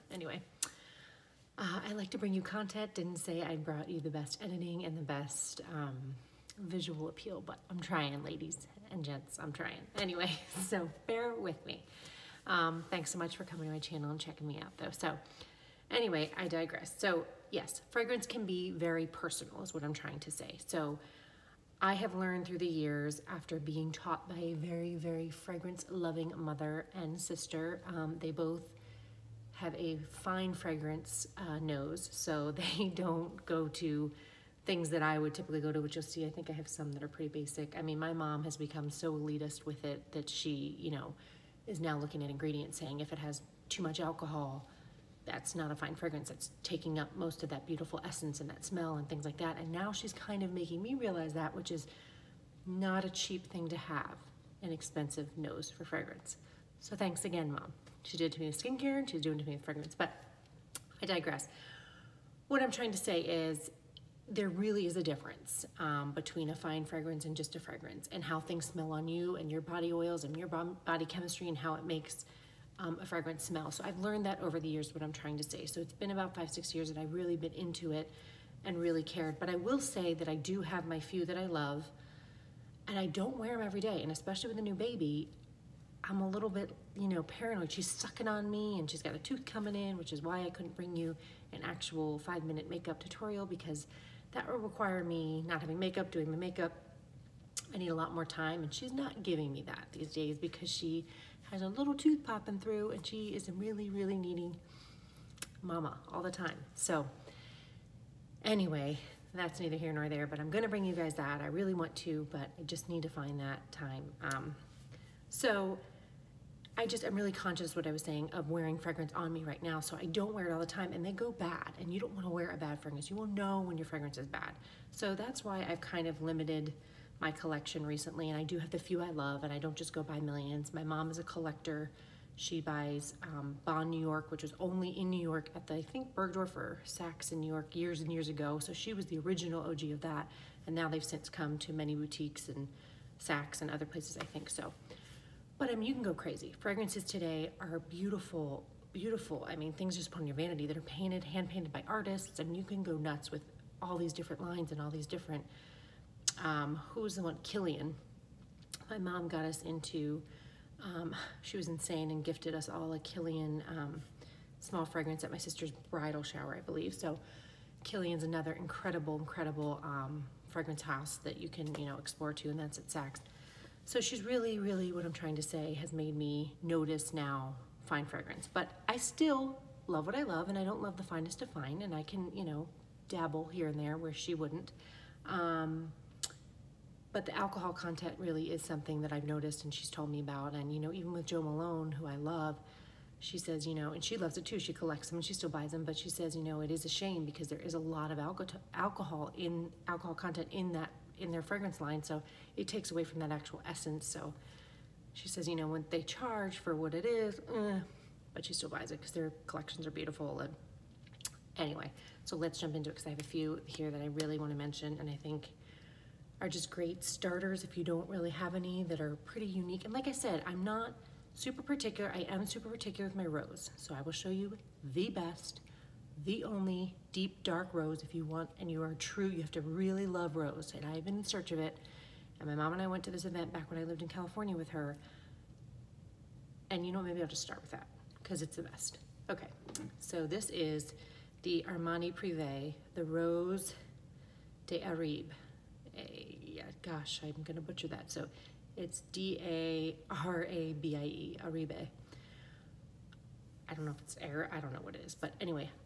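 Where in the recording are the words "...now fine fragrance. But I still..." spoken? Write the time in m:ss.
2:57.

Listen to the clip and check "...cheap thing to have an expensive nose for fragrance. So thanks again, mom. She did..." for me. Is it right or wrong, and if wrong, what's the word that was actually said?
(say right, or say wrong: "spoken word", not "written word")
right.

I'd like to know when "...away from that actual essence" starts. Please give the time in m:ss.
3:22.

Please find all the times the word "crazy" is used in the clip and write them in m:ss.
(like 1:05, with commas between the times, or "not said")
2:26.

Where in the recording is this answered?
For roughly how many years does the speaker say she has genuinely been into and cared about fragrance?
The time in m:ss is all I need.
1:16.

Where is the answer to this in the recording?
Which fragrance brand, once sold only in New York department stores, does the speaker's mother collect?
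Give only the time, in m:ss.
2:13.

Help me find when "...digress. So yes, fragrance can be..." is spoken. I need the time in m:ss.
0:16.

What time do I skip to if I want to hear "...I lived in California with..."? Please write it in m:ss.
3:53.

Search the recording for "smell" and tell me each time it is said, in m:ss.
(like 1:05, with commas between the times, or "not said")
0:48, 1:08, 1:13.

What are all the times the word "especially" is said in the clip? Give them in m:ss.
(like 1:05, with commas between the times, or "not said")
1:24.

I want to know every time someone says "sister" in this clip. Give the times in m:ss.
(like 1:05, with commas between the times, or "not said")
0:27, 2:45.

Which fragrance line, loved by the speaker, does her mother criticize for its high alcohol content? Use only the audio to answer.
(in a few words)
Jo Malone.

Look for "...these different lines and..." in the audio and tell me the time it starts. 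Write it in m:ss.
2:33.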